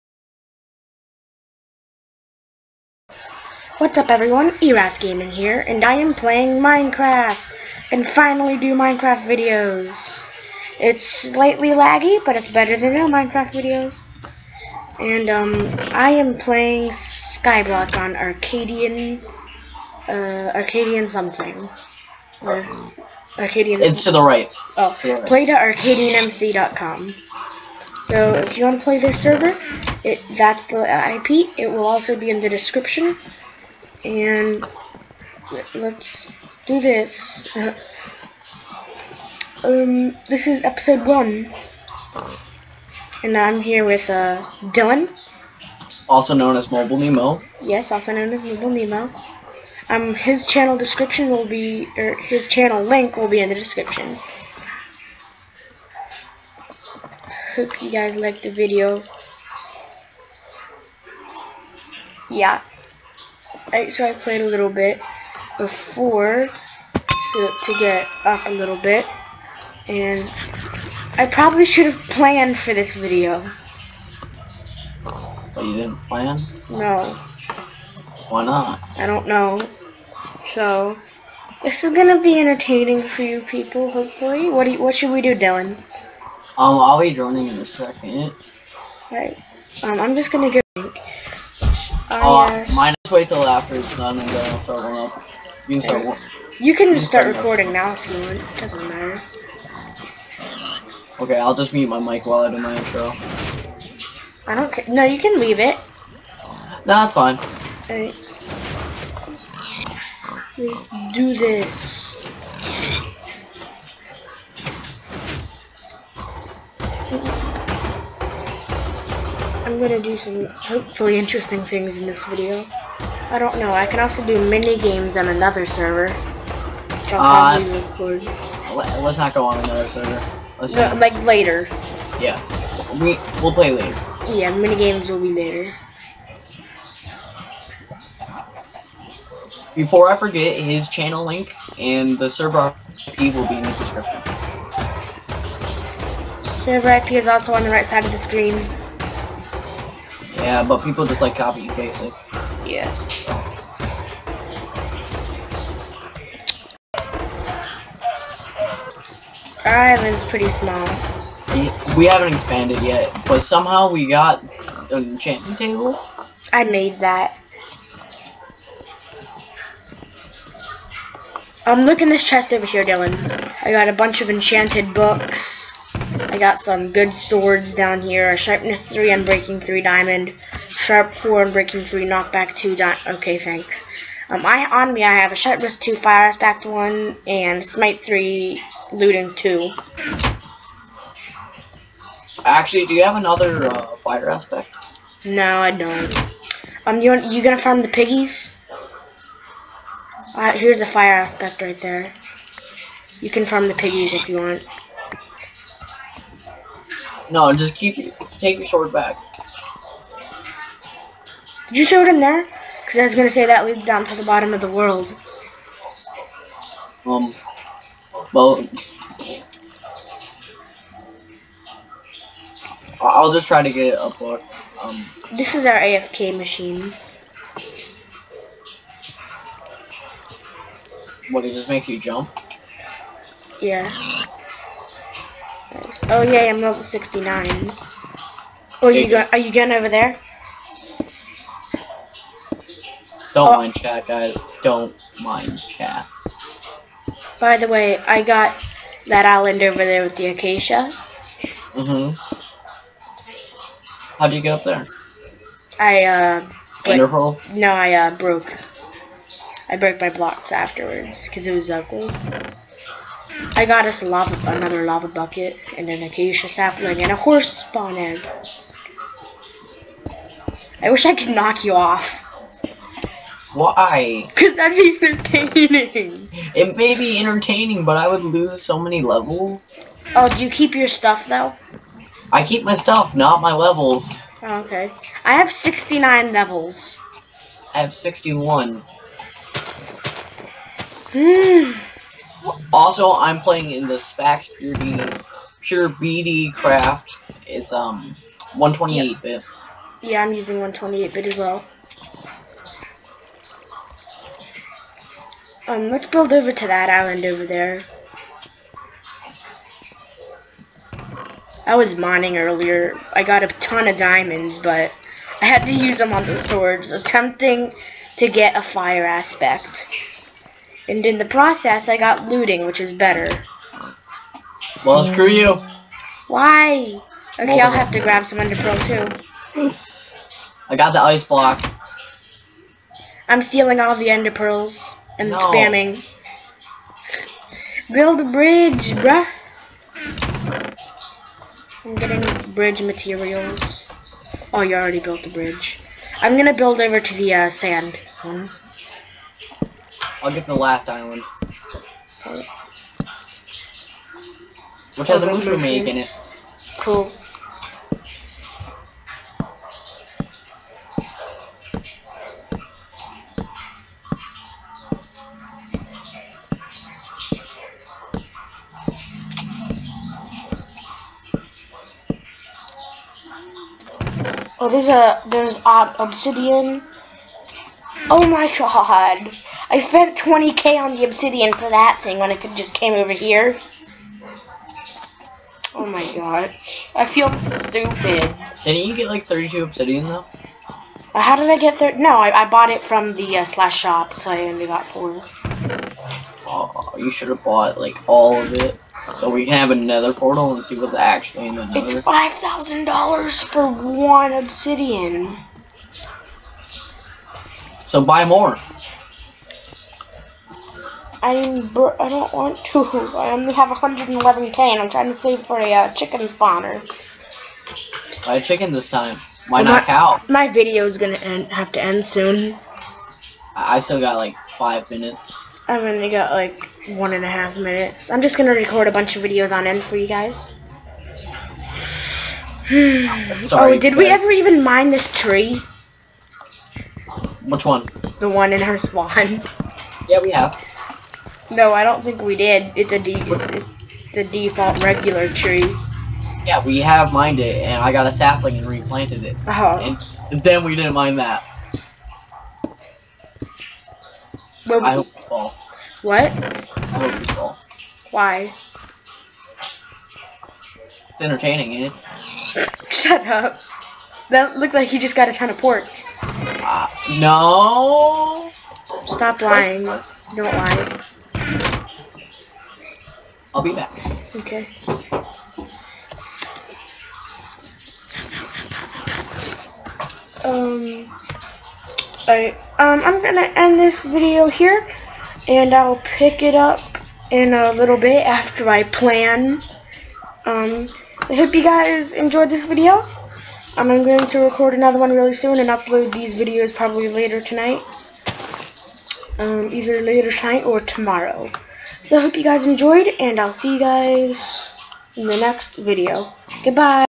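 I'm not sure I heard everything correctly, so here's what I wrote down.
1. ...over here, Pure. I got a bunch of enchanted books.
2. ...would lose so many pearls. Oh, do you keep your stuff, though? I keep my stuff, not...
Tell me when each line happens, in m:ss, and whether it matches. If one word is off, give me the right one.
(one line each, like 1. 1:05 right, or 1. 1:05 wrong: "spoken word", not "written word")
1. 2:52 wrong: "Dylan", not "Pure"
2. 4:38 wrong: "levels", not "pearls".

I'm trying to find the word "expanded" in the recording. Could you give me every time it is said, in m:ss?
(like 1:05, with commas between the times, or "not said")
2:42.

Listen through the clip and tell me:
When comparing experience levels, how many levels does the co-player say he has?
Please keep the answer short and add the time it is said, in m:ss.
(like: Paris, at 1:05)
61, at 4:47.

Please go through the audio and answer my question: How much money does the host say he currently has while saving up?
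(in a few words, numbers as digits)
111k.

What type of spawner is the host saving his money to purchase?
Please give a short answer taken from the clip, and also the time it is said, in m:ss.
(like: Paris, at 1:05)
chicken spawner, at 6:55.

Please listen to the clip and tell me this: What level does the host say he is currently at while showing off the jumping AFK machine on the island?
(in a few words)
69.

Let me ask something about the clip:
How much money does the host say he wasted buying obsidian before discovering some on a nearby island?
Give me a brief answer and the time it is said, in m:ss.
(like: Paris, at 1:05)
20k, at 6:20.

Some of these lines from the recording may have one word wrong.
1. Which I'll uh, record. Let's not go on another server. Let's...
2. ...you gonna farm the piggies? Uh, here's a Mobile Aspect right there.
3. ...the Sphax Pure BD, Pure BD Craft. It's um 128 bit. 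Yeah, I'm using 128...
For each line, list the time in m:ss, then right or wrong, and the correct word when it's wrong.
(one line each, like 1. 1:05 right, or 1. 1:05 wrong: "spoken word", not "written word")
1. 2:06 right
2. 3:17 wrong: "Fire", not "Mobile"
3. 4:53 right.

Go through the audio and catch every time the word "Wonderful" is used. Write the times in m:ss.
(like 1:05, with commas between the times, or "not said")
4:16.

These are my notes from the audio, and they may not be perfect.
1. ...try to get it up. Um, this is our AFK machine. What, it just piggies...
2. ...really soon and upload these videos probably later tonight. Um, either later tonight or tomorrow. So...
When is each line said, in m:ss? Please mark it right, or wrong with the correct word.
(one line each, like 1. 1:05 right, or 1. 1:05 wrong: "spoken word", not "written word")
1. 3:43 wrong: "makes", not "piggies"
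2. 8:15 right.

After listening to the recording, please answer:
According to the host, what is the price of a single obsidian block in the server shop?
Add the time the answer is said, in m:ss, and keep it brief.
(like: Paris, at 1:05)
5000 dollars, at 6:42.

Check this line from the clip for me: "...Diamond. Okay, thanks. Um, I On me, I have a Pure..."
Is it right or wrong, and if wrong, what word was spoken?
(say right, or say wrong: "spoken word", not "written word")
wrong: "Sharpness", not "Pure".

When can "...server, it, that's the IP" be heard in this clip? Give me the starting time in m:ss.
0:29.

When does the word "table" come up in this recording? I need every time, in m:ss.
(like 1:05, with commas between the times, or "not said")
2:45.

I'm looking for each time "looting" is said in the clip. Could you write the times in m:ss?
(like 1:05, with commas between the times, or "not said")
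3:08, 5:22.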